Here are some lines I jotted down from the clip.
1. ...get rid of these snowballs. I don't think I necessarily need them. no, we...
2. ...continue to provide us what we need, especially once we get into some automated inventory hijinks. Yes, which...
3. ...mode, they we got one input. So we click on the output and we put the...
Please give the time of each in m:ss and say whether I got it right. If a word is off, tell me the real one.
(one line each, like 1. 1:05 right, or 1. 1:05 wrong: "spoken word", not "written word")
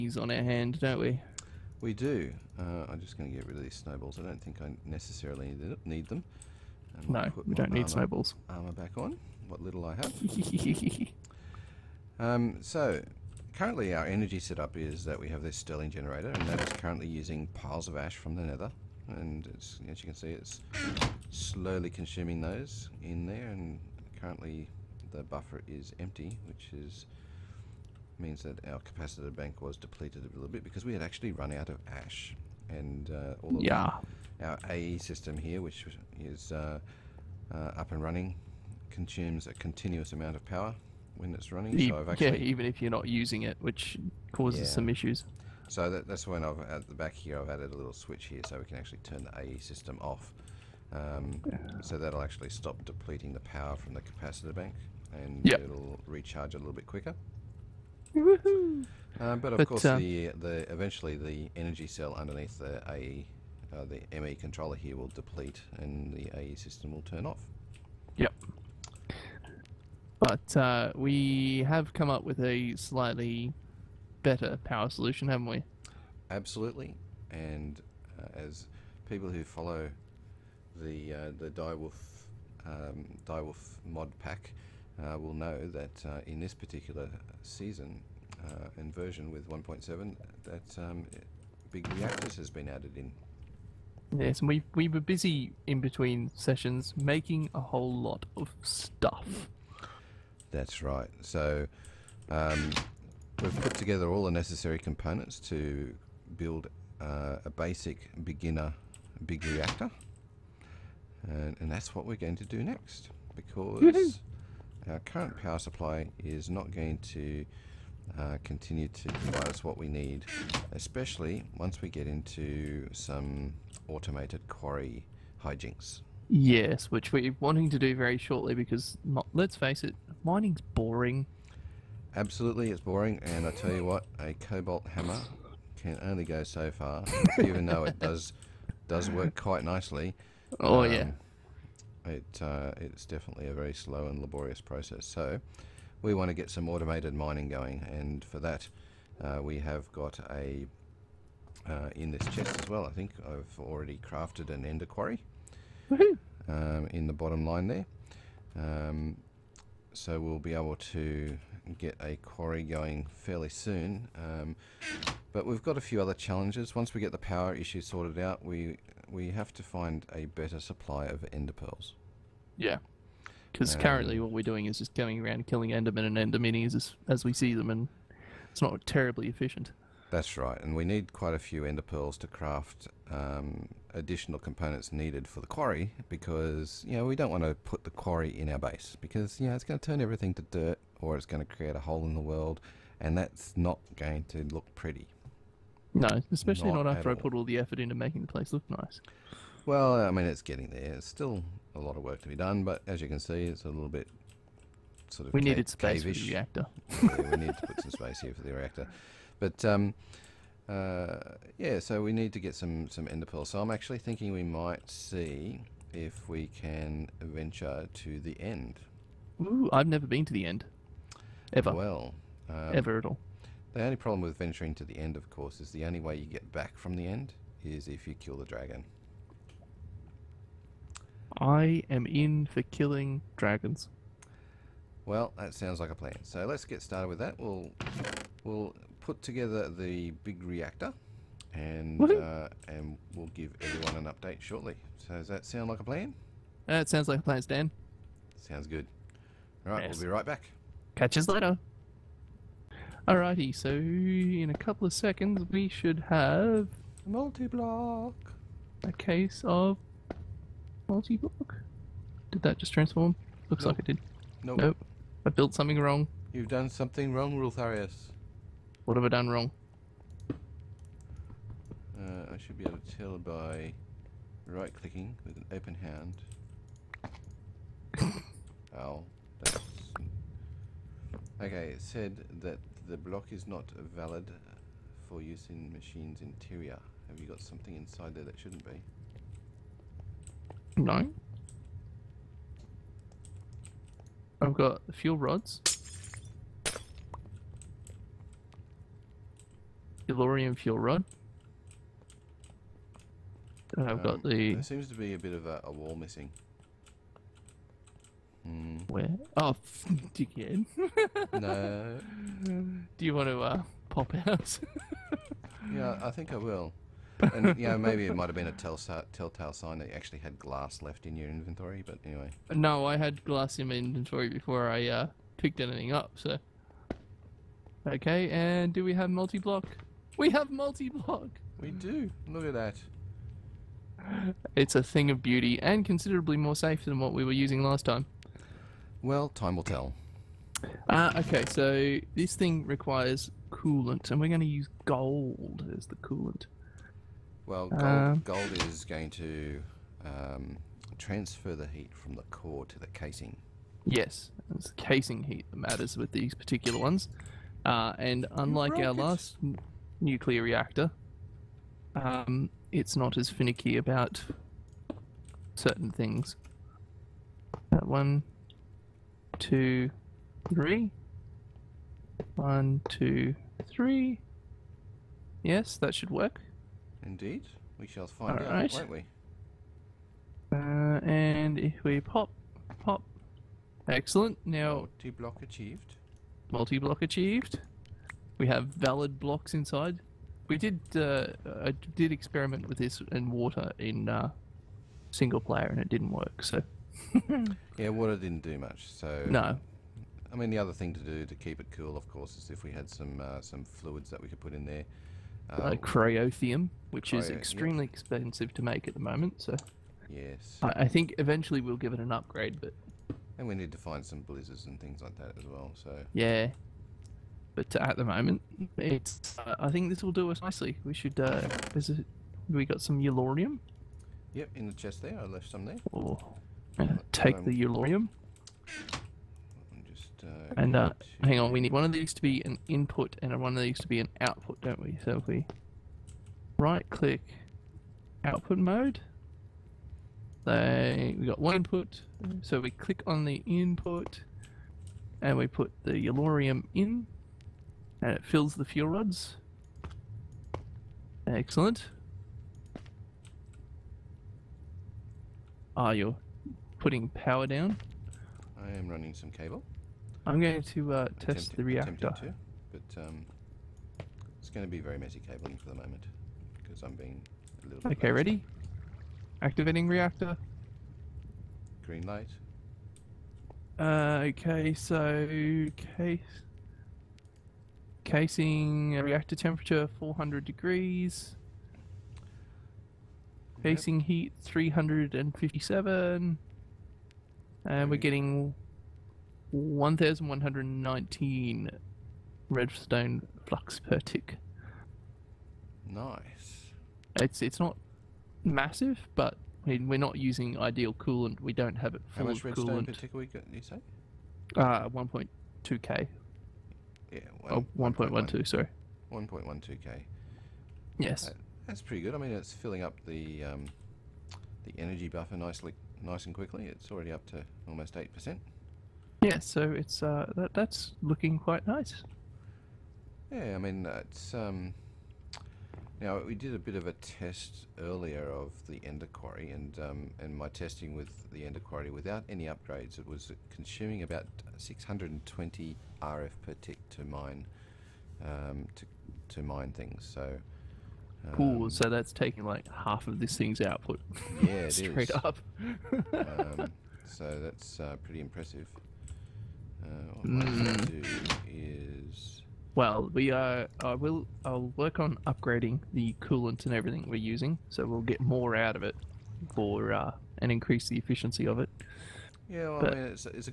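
1. 0:03 right
2. 1:58 wrong: "quarry", not "inventory"
3. 7:18 wrong: "input", not "output".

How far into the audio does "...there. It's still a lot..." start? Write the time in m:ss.
3:20.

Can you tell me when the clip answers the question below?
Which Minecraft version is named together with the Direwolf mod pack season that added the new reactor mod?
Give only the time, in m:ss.
1:29.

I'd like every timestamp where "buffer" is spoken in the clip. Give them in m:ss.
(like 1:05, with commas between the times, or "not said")
0:25, 8:35.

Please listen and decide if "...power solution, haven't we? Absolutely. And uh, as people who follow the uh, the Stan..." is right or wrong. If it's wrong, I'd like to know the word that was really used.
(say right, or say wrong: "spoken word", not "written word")
wrong: "Direwolf", not "Stan".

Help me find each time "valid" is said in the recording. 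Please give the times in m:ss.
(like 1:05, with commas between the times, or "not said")
4:43, 6:28.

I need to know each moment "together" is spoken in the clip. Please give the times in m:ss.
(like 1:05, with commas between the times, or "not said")
1:43, 3:59.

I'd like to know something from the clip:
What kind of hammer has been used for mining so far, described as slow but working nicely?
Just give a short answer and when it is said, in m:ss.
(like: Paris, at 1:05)
Cobalt hammer, at 2:14.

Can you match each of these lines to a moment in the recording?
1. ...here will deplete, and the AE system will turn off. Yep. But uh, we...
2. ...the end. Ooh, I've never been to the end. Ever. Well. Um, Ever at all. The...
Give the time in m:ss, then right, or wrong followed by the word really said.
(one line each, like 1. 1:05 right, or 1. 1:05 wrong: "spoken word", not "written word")
1. 1:04 right
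2. 3:38 right.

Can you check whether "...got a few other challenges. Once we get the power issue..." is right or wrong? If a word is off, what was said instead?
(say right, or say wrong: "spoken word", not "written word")
right.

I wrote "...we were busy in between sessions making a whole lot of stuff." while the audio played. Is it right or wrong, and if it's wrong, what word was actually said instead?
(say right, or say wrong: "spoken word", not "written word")
right.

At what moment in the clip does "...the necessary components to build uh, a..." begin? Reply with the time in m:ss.
1:44.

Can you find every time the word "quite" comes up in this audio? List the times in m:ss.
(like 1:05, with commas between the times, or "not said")
2:19, 3:01, 8:41.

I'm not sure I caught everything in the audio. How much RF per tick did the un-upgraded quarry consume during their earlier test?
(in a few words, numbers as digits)
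620.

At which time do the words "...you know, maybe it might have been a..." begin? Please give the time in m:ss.
5:17.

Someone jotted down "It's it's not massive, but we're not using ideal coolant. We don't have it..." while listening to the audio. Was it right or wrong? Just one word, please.
right.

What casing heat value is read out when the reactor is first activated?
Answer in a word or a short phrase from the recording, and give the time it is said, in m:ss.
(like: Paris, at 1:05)
357, at 8:04.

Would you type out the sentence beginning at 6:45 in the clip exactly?
Um, uh, cryotheum, which cryo, is extremely expensive to make at the moment.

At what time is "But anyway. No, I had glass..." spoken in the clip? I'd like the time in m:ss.
5:21.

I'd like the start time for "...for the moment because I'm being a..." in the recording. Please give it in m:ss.
7:45.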